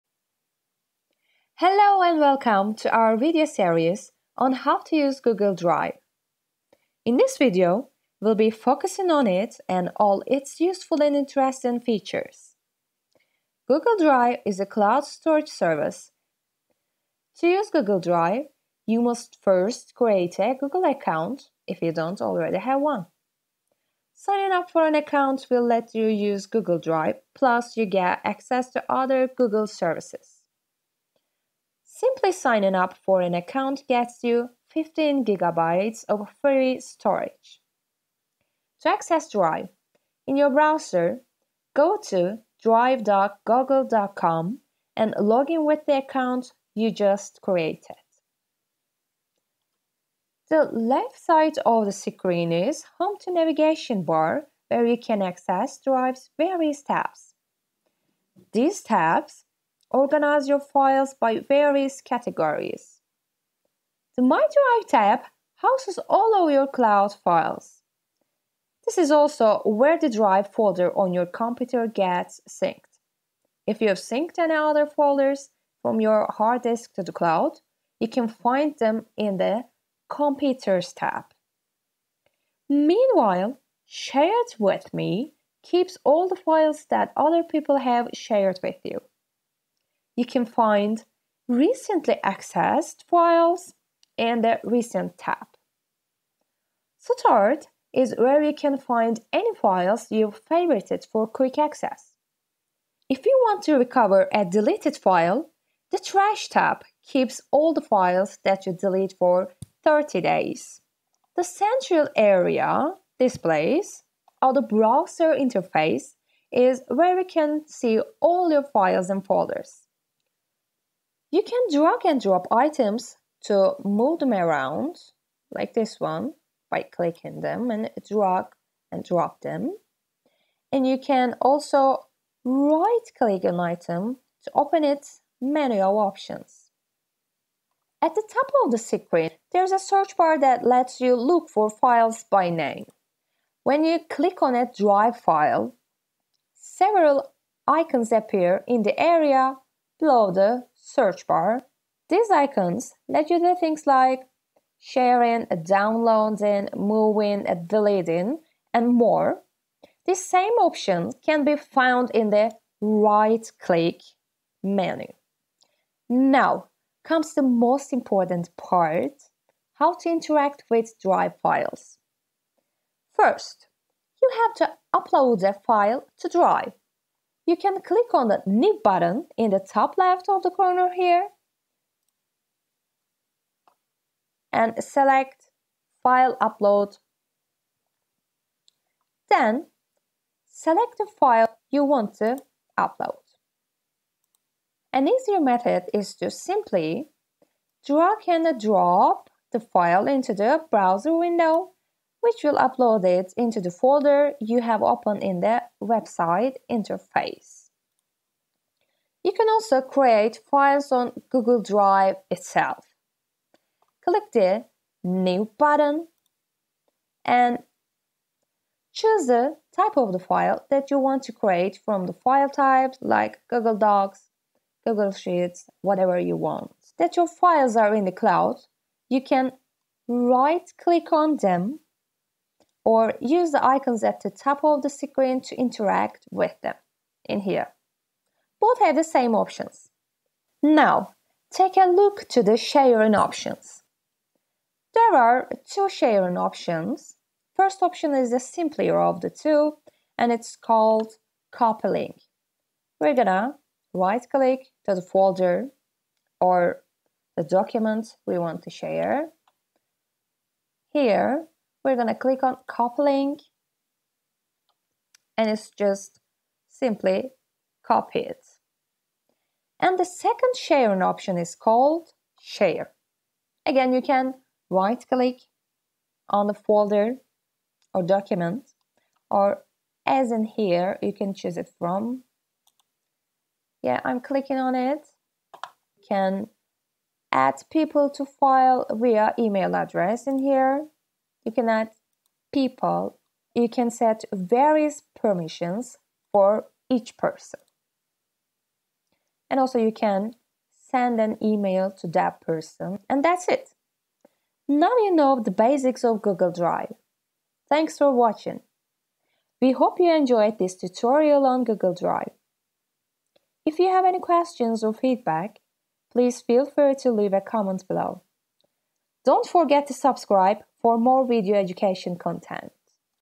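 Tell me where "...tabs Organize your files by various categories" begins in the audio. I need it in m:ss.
0:58.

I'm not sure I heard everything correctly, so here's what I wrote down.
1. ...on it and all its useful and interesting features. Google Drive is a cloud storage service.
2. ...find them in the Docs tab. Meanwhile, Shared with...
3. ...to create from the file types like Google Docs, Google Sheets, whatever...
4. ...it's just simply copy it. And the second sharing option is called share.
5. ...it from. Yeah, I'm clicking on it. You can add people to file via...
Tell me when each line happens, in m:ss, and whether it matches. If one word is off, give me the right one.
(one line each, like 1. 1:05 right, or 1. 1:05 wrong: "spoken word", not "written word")
1. 0:09 right
2. 1:18 wrong: "Computers", not "Docs"
3. 3:41 right
4. 4:25 right
5. 4:41 right.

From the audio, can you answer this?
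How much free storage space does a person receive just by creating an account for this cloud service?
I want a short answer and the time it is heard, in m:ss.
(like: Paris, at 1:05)
15 gigabytes, at 0:34.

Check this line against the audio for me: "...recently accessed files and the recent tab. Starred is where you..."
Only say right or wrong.
right.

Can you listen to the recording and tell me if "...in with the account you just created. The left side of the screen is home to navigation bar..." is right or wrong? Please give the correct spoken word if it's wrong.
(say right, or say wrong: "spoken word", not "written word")
right.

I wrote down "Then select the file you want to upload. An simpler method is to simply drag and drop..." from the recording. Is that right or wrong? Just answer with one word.
wrong.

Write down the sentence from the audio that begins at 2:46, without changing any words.
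Now comes the most important part how to interact with Drive files.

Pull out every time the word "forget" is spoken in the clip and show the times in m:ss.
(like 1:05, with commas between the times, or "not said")
5:19.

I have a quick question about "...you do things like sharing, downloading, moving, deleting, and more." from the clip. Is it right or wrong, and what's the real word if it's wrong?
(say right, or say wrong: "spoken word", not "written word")
right.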